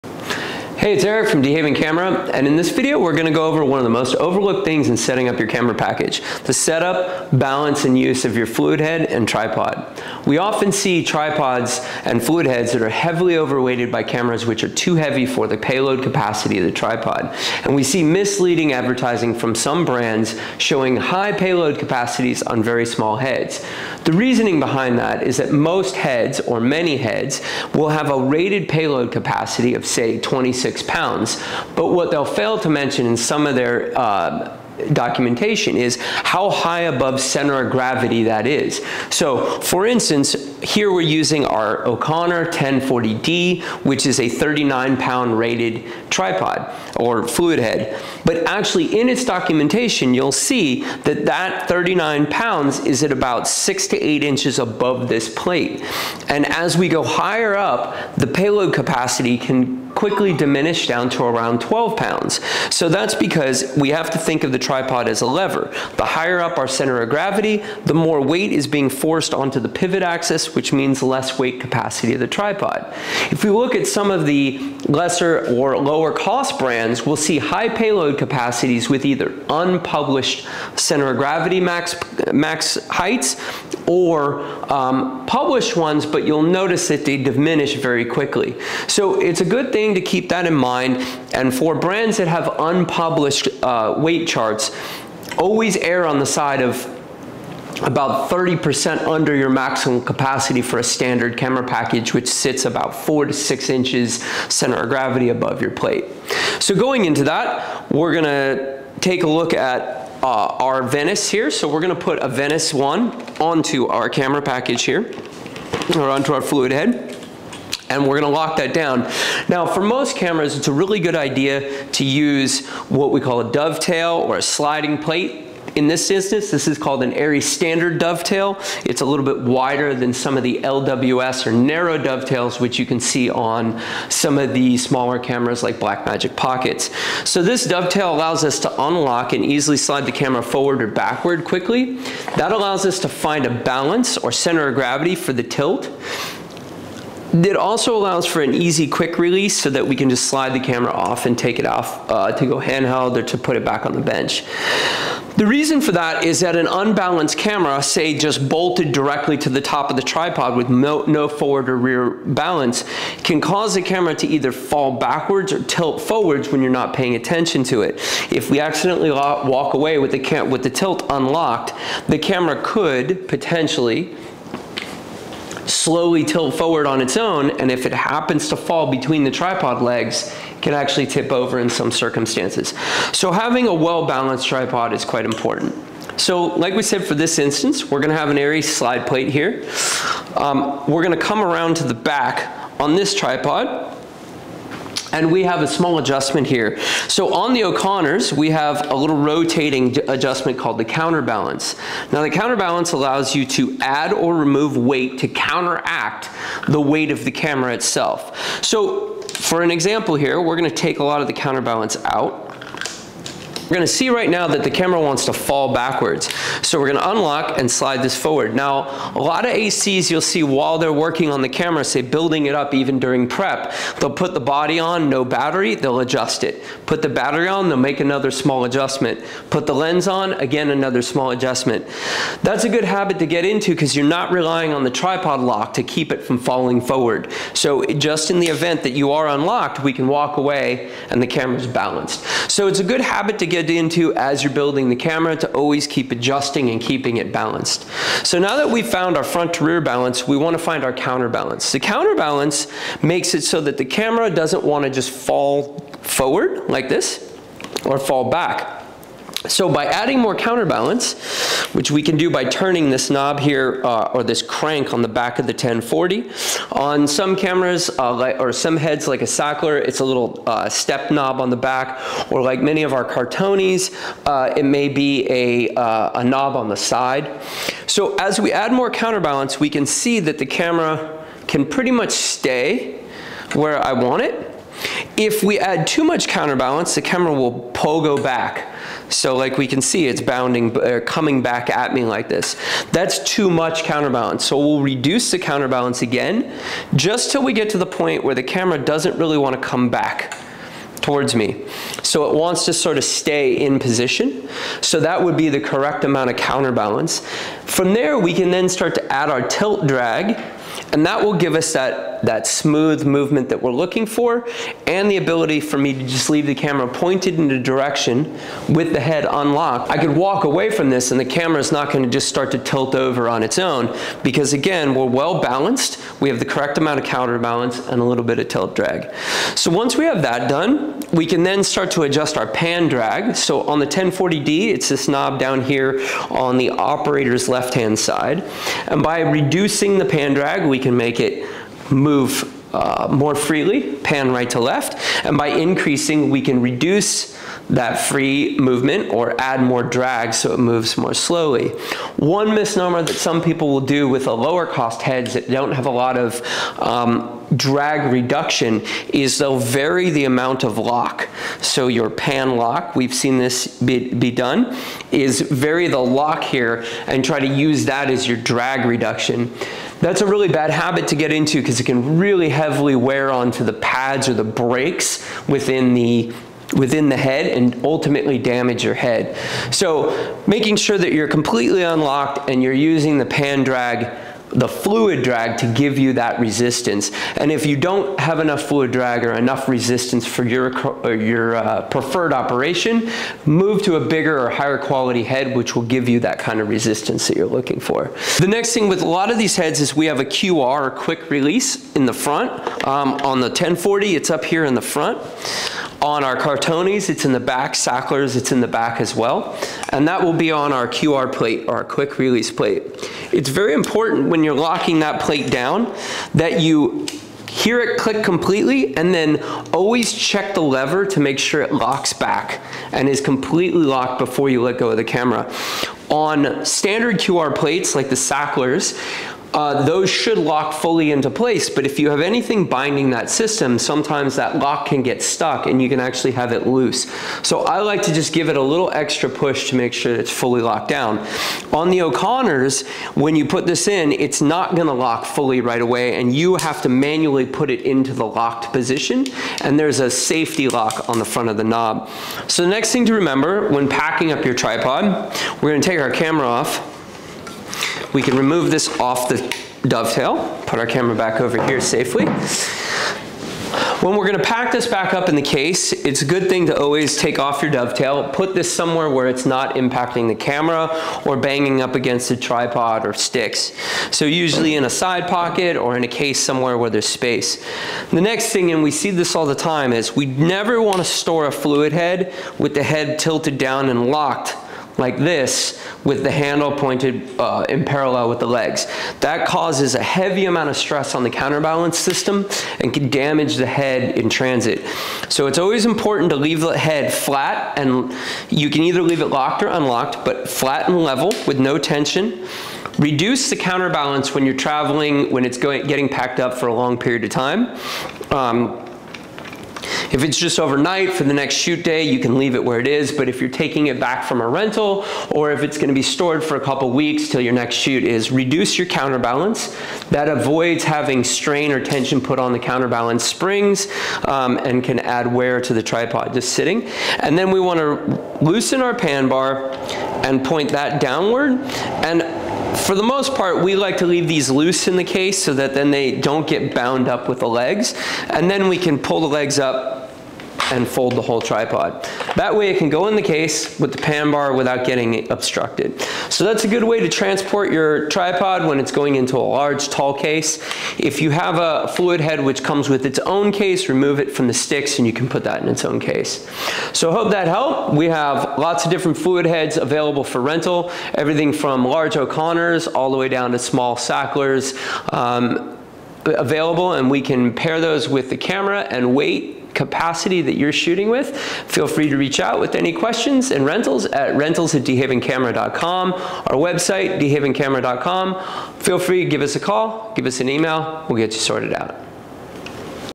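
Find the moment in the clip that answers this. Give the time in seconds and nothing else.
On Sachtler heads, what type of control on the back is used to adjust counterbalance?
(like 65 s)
270 s.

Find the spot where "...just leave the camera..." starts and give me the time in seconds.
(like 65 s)
315 s.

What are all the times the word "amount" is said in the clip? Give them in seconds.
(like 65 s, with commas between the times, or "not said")
306 s, 326 s, 360 s, 490 s.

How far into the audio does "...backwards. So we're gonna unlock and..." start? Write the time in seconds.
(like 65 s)
215 s.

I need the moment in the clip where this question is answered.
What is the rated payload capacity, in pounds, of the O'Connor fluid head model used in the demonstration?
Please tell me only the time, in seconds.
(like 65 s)
44 s.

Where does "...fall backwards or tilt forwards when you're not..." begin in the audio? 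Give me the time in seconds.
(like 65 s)
164 s.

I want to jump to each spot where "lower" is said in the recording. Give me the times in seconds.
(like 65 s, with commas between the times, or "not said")
75 s, 354 s.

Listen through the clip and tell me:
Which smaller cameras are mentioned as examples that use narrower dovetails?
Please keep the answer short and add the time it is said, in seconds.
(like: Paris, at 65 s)
Blackmagic Pockets, at 135 s.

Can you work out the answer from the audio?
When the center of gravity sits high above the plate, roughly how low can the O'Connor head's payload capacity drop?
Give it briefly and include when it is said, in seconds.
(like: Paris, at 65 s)
12 pounds, at 61 s.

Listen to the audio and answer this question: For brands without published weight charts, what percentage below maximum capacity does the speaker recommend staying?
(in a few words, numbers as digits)
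30%.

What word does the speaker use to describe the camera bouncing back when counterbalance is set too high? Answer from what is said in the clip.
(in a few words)
pogo.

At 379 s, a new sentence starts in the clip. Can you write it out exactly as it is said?
So making sure that you're completely unlocked and you're using the pan drag the fluid drag to give you that resistance.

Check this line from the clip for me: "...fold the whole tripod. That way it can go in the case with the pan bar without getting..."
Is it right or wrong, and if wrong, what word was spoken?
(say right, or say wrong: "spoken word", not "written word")
right.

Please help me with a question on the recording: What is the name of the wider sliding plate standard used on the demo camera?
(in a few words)
ARRI Standard Dovetail.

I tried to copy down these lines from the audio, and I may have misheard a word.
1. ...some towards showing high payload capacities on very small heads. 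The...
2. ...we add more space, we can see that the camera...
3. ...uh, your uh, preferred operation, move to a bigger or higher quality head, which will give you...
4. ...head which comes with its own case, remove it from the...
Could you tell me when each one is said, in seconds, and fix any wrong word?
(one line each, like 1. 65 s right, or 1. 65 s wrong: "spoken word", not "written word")
1. 19 s wrong: "brands", not "towards"
2. 278 s wrong: "counterbalance", not "space"
3. 391 s right
4. 552 s right.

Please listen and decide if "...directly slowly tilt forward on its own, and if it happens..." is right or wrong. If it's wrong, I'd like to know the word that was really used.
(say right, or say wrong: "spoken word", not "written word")
wrong: "potentially", not "directly".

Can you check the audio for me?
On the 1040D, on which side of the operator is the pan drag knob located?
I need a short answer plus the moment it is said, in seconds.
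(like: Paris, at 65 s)
left-hand side, at 337 s.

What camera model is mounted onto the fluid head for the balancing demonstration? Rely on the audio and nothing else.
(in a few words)
Venice 1.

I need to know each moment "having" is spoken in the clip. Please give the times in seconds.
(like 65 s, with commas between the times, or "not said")
183 s, 520 s.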